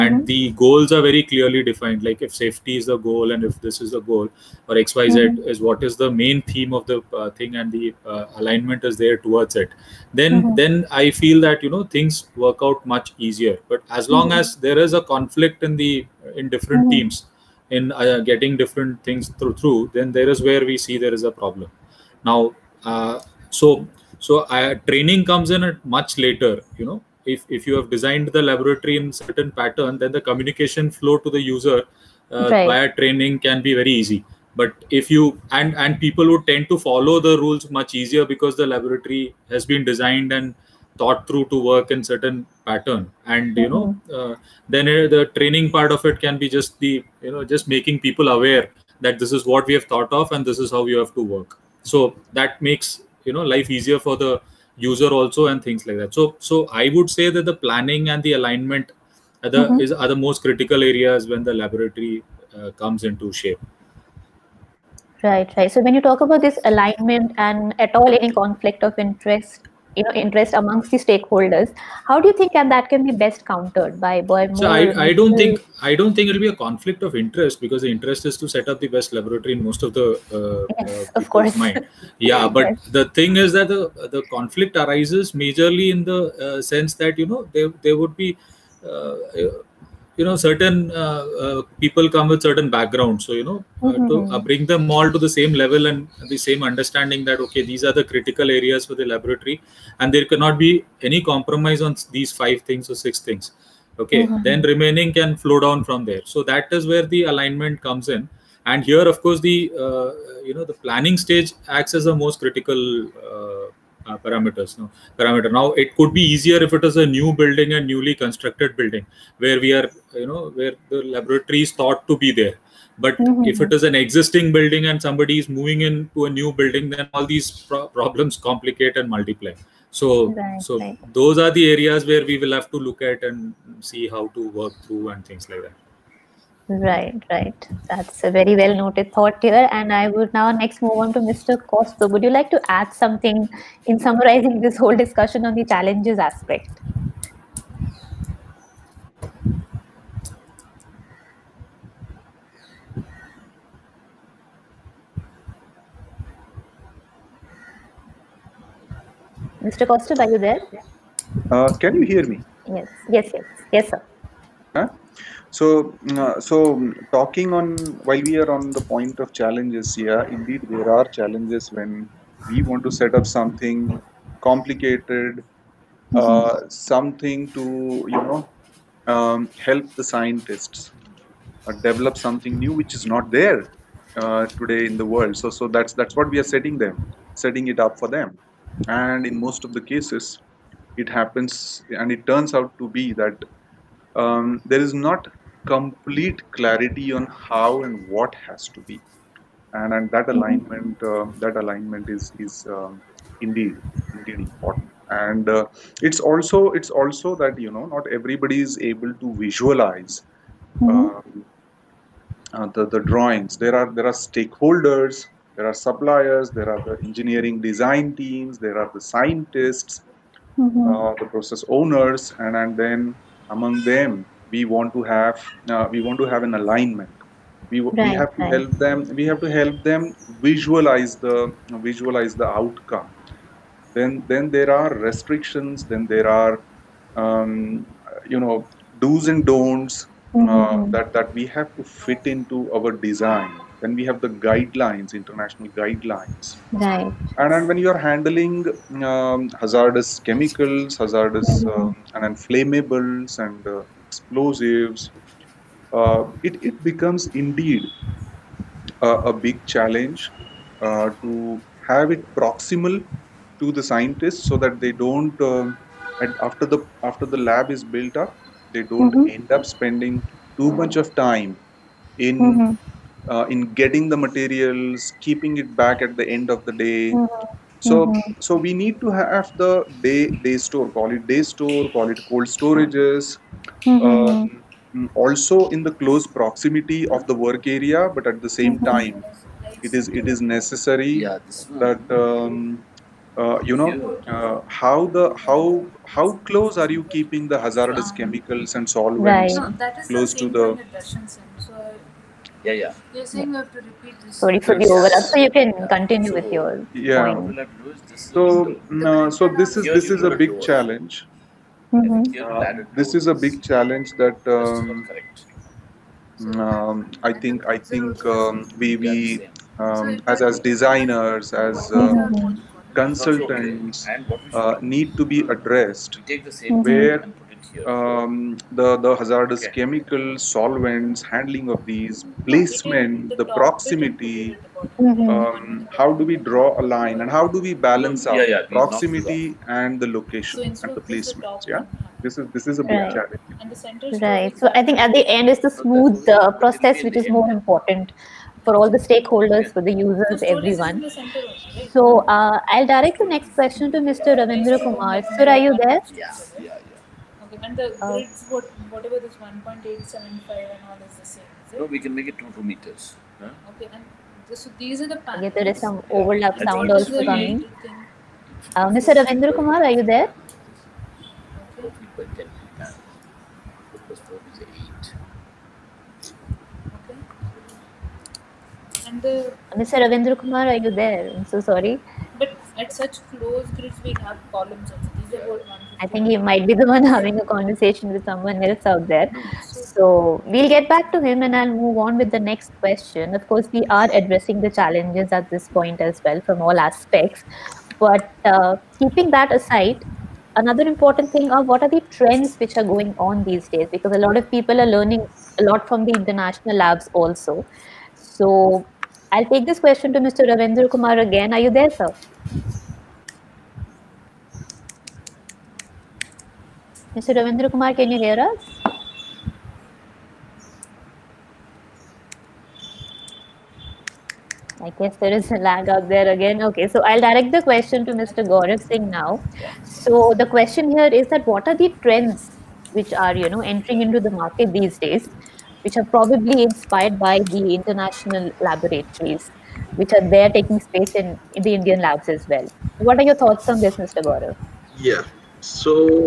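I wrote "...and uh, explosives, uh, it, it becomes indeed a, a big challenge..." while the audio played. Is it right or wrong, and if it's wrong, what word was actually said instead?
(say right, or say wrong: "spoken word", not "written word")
right.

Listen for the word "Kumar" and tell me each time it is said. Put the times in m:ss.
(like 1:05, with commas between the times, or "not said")
5:54, 6:09, 6:20, 6:50, 6:57.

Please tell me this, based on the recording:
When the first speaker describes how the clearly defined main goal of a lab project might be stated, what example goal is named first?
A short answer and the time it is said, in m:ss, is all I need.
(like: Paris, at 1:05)
safety, at 0:02.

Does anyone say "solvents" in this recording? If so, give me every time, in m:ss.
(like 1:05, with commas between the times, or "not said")
4:58, 5:30.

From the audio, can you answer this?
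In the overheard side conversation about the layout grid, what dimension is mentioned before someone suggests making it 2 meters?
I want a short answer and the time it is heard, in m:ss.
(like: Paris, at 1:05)
1.875, at 5:59.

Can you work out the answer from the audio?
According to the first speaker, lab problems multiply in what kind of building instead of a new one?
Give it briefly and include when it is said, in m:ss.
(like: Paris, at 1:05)
existing building, at 2:03.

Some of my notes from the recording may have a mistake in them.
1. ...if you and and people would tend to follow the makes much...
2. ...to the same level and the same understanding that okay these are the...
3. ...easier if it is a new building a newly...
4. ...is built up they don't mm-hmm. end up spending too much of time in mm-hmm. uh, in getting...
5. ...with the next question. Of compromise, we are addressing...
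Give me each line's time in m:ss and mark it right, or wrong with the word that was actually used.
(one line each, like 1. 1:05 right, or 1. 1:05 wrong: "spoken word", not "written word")
1. 0:34 wrong: "rules", not "makes"
2. 1:35 right
3. 1:56 right
4. 4:27 right
5. 6:32 wrong: "course", not "compromise".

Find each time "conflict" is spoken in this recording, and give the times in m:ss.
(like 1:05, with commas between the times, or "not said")
0:15, 1:08, 1:16, 1:24.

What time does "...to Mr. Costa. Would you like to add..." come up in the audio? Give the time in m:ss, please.
2:21.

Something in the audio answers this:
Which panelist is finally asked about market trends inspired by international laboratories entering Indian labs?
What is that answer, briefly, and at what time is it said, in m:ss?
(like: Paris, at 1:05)
Mr. Gaurav Singh, at 7:08.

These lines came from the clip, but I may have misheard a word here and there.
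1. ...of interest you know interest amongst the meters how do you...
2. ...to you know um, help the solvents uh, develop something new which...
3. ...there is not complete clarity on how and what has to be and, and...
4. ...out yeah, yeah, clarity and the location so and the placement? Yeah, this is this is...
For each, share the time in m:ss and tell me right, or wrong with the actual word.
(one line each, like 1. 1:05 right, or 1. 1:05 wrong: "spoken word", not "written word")
1. 1:08 wrong: "stakeholders", not "meters"
2. 2:57 wrong: "scientists", not "solvents"
3. 3:14 right
4. 5:38 wrong: "proximity", not "clarity".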